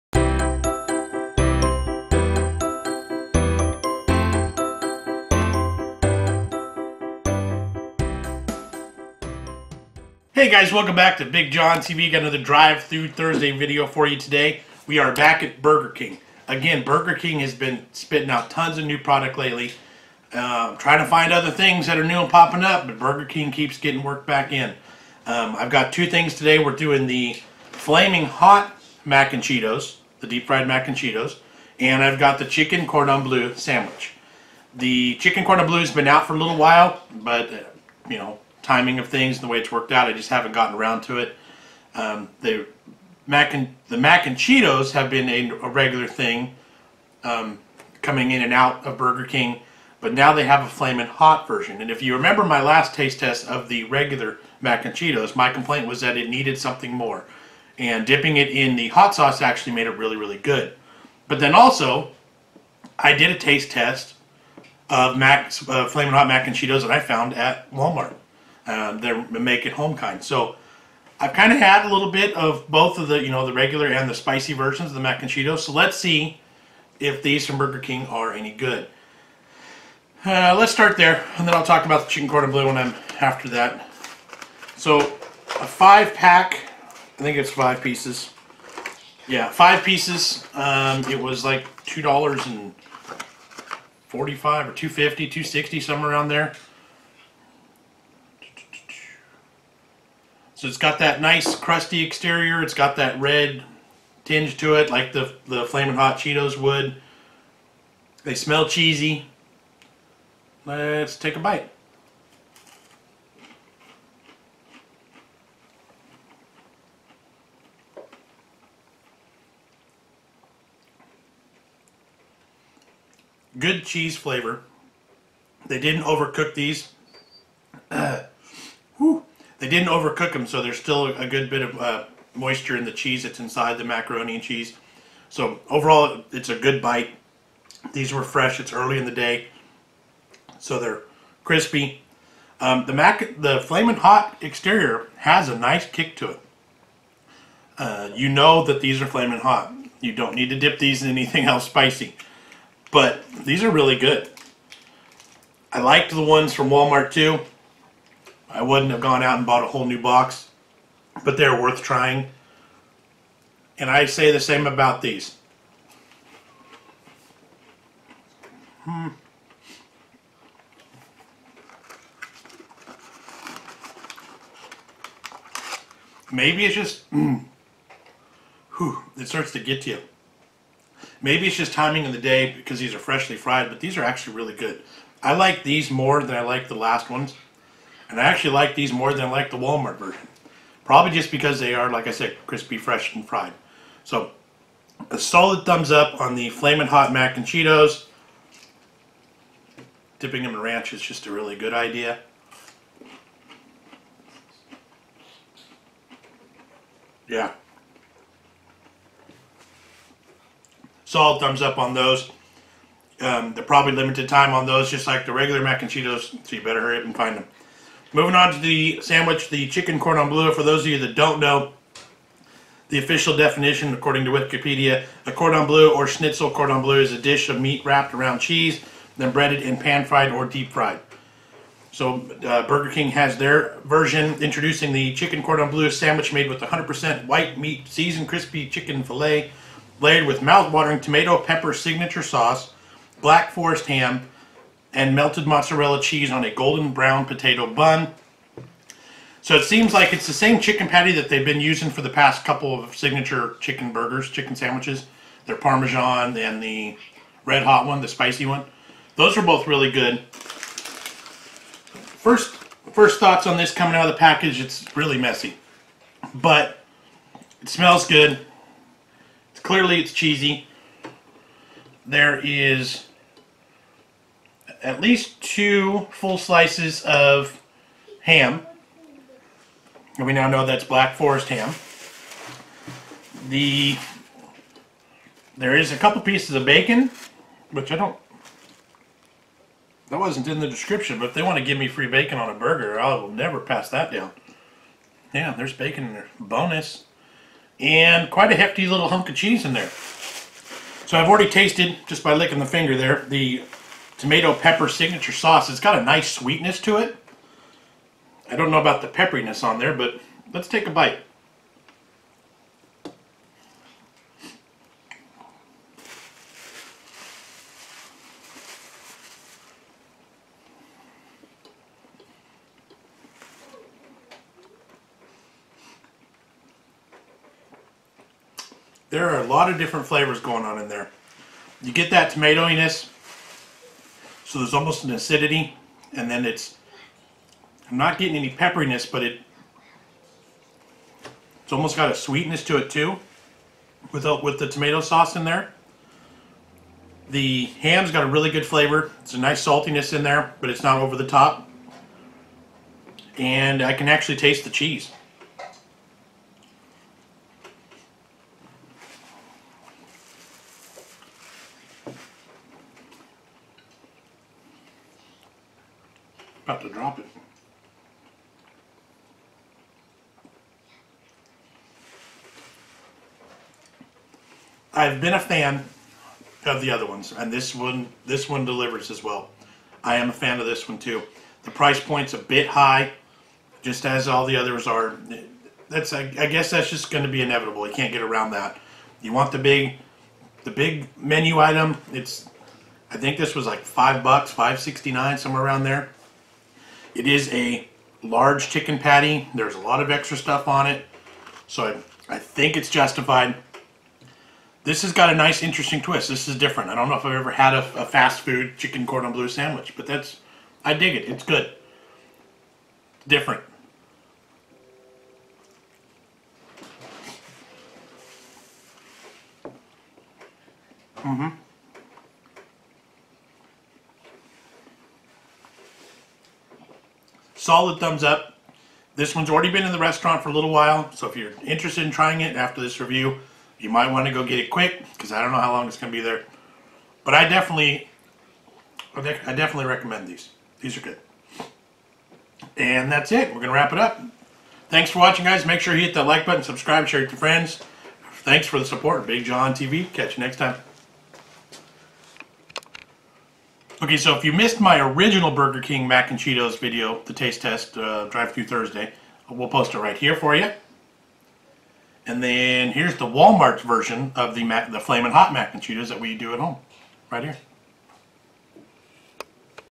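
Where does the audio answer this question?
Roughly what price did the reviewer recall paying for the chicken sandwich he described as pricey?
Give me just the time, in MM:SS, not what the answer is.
06:34.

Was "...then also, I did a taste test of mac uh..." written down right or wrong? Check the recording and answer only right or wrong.
right.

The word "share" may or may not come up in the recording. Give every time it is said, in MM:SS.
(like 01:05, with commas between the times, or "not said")
07:27.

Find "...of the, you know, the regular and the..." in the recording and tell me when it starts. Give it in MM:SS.
01:12.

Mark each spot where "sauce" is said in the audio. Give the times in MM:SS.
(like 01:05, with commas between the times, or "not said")
00:59, 04:02, 05:05, 05:44.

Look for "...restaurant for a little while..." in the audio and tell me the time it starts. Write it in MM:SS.
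07:09.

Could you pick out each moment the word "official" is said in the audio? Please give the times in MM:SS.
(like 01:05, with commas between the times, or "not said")
03:42.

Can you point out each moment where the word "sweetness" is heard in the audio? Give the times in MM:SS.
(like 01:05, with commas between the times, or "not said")
05:06, 05:42.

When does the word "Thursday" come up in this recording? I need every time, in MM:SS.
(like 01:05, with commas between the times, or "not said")
00:13, 07:38.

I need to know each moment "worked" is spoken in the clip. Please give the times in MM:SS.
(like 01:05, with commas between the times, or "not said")
00:24, 00:39.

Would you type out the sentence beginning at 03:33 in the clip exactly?
Um, they're probably limited time on those, just like the regular mac and Cheetos, so you better hurry up and find them.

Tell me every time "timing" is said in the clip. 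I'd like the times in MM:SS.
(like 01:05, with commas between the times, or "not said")
00:38, 03:01.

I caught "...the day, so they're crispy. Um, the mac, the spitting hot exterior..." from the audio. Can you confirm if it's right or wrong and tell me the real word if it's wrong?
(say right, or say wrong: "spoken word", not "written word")
wrong: "flaming", not "spitting".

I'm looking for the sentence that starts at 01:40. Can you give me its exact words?
So it's got that nice crusty exterior.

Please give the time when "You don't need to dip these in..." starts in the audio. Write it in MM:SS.
02:30.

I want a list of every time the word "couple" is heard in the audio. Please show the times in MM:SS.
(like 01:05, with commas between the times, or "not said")
04:12, 04:45.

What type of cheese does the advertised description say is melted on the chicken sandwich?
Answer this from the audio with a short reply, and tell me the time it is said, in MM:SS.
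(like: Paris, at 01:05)
Mozzarella, at 04:05.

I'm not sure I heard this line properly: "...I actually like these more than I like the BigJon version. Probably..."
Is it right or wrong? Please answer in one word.
wrong.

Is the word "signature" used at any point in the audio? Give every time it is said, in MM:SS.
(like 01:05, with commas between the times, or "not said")
04:01, 04:12, 05:04.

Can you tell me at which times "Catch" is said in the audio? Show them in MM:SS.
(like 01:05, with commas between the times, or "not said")
07:30.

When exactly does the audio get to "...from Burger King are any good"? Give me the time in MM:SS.
01:17.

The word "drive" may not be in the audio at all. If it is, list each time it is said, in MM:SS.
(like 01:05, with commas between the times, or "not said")
00:12, 07:38.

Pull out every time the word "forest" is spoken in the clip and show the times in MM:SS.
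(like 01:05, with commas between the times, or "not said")
04:03, 04:41.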